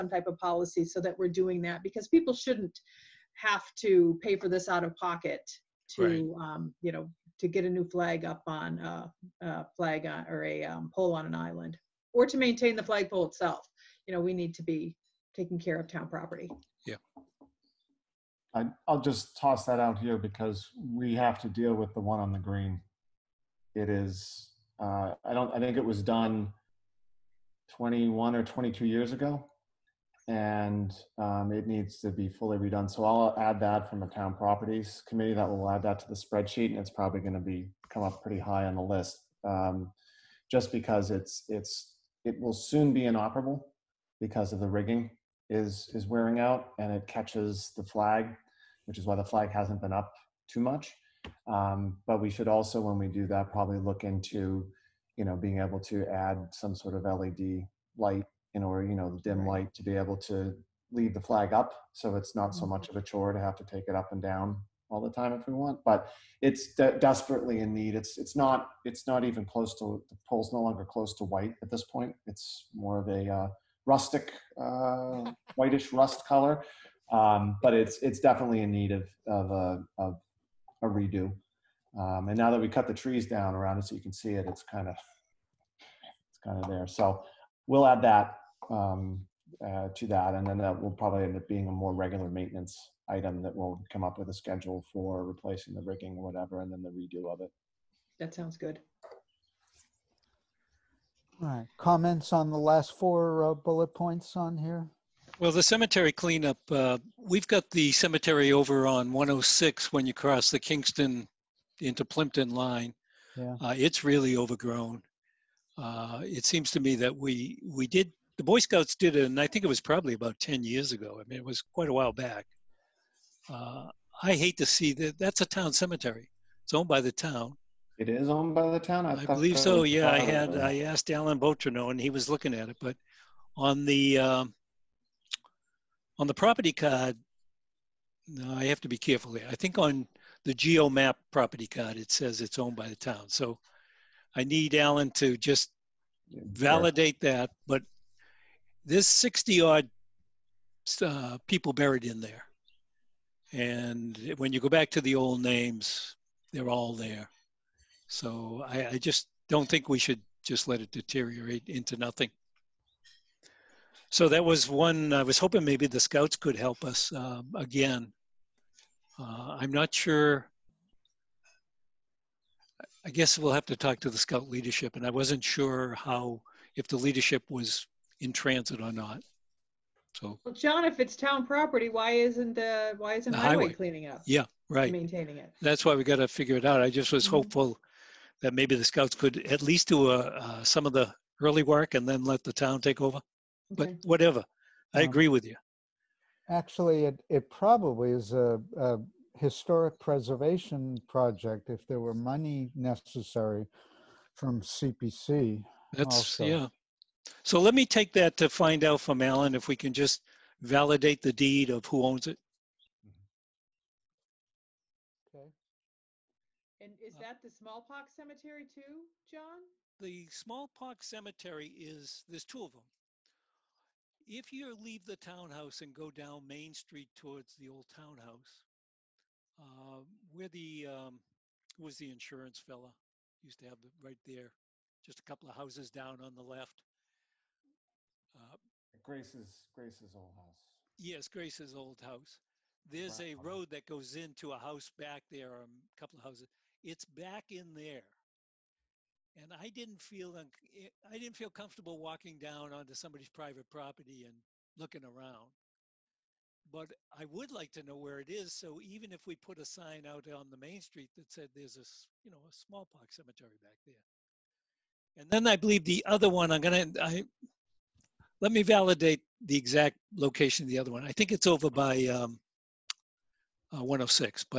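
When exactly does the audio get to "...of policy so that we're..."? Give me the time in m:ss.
0:00.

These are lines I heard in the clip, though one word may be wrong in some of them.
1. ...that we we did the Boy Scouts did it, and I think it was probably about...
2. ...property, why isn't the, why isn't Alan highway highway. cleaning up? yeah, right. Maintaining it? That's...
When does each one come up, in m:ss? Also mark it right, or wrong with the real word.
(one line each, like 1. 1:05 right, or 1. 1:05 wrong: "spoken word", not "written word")
1. 1:56 right
2. 3:01 wrong: "The", not "Alan".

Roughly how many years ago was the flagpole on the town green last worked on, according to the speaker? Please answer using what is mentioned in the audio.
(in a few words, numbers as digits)
21 or 22 years.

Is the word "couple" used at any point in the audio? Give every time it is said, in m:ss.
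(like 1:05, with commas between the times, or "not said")
3:55, 4:05.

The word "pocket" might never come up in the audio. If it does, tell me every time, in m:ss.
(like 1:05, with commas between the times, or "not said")
0:04.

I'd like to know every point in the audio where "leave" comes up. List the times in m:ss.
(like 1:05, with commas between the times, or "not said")
1:00, 3:44.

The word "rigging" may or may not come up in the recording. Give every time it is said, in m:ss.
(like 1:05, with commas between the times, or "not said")
0:44, 1:35.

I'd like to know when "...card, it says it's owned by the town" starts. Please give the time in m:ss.
2:21.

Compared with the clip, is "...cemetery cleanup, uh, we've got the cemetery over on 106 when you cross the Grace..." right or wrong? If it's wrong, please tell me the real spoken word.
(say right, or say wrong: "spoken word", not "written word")
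wrong: "Kingston", not "Grace".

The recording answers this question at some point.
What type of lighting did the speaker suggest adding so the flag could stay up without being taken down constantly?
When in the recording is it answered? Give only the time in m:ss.
0:57.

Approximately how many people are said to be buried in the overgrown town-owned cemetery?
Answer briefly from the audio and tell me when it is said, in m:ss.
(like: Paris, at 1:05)
60, at 2:29.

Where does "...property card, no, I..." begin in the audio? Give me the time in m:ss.
2:16.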